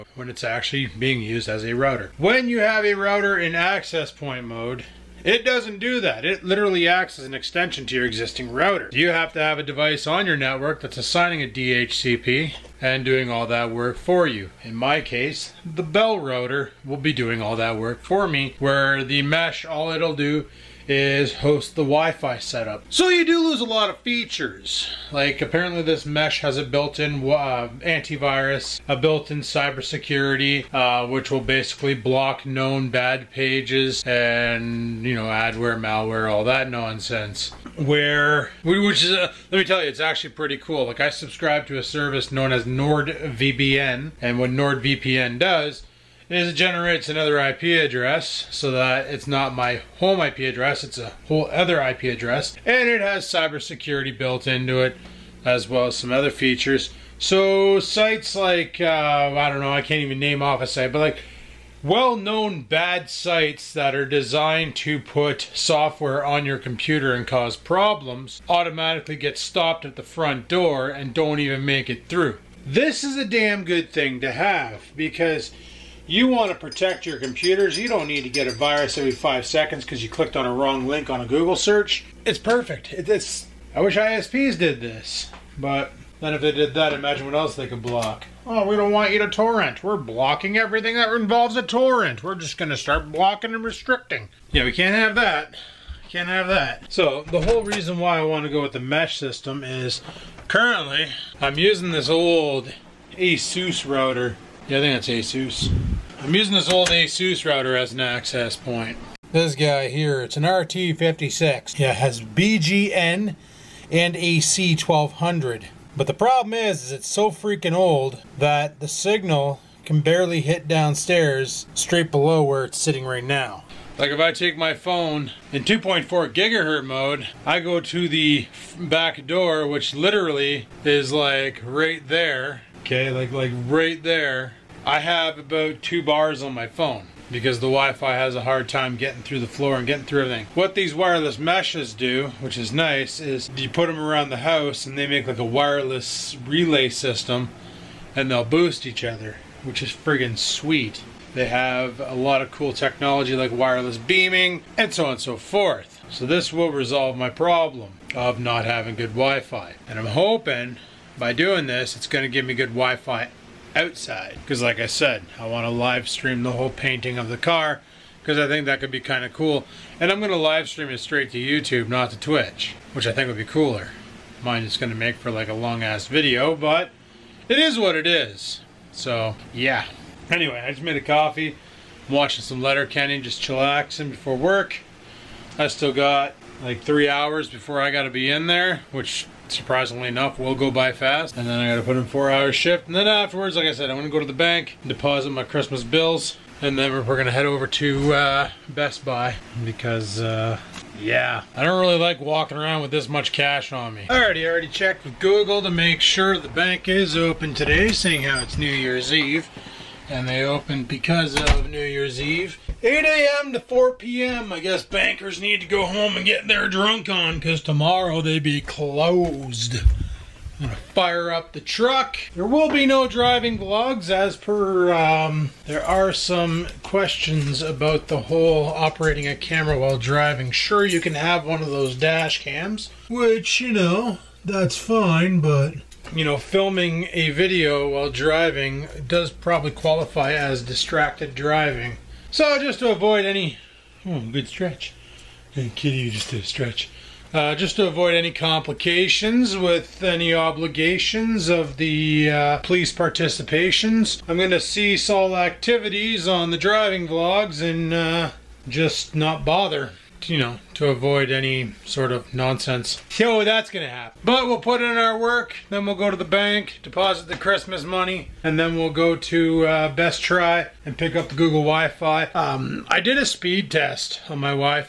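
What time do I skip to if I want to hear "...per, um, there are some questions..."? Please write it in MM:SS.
03:44.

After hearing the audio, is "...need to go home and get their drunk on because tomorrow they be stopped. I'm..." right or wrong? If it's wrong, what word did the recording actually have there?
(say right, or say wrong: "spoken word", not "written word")
wrong: "closed", not "stopped".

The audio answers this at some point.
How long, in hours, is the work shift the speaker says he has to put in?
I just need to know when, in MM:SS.
03:12.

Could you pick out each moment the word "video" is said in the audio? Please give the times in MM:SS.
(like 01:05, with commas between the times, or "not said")
02:56, 03:57.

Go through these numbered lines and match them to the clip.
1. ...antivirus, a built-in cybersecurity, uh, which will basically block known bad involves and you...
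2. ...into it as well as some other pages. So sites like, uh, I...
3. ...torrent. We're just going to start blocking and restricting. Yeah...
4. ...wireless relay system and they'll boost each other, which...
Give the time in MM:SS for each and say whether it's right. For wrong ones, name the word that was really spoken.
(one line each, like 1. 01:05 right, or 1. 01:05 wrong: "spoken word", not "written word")
1. 00:27 wrong: "pages", not "involves"
2. 00:54 wrong: "features", not "pages"
3. 01:31 right
4. 02:25 right.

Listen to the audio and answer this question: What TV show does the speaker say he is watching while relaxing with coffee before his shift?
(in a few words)
Letterkenny.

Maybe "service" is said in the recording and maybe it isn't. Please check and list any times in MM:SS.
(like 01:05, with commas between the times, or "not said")
00:41.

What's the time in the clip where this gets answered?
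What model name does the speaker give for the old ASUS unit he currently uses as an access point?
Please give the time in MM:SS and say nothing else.
01:50.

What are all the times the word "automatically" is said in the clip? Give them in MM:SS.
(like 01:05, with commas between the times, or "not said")
01:08.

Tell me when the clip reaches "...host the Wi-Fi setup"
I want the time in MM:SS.
00:21.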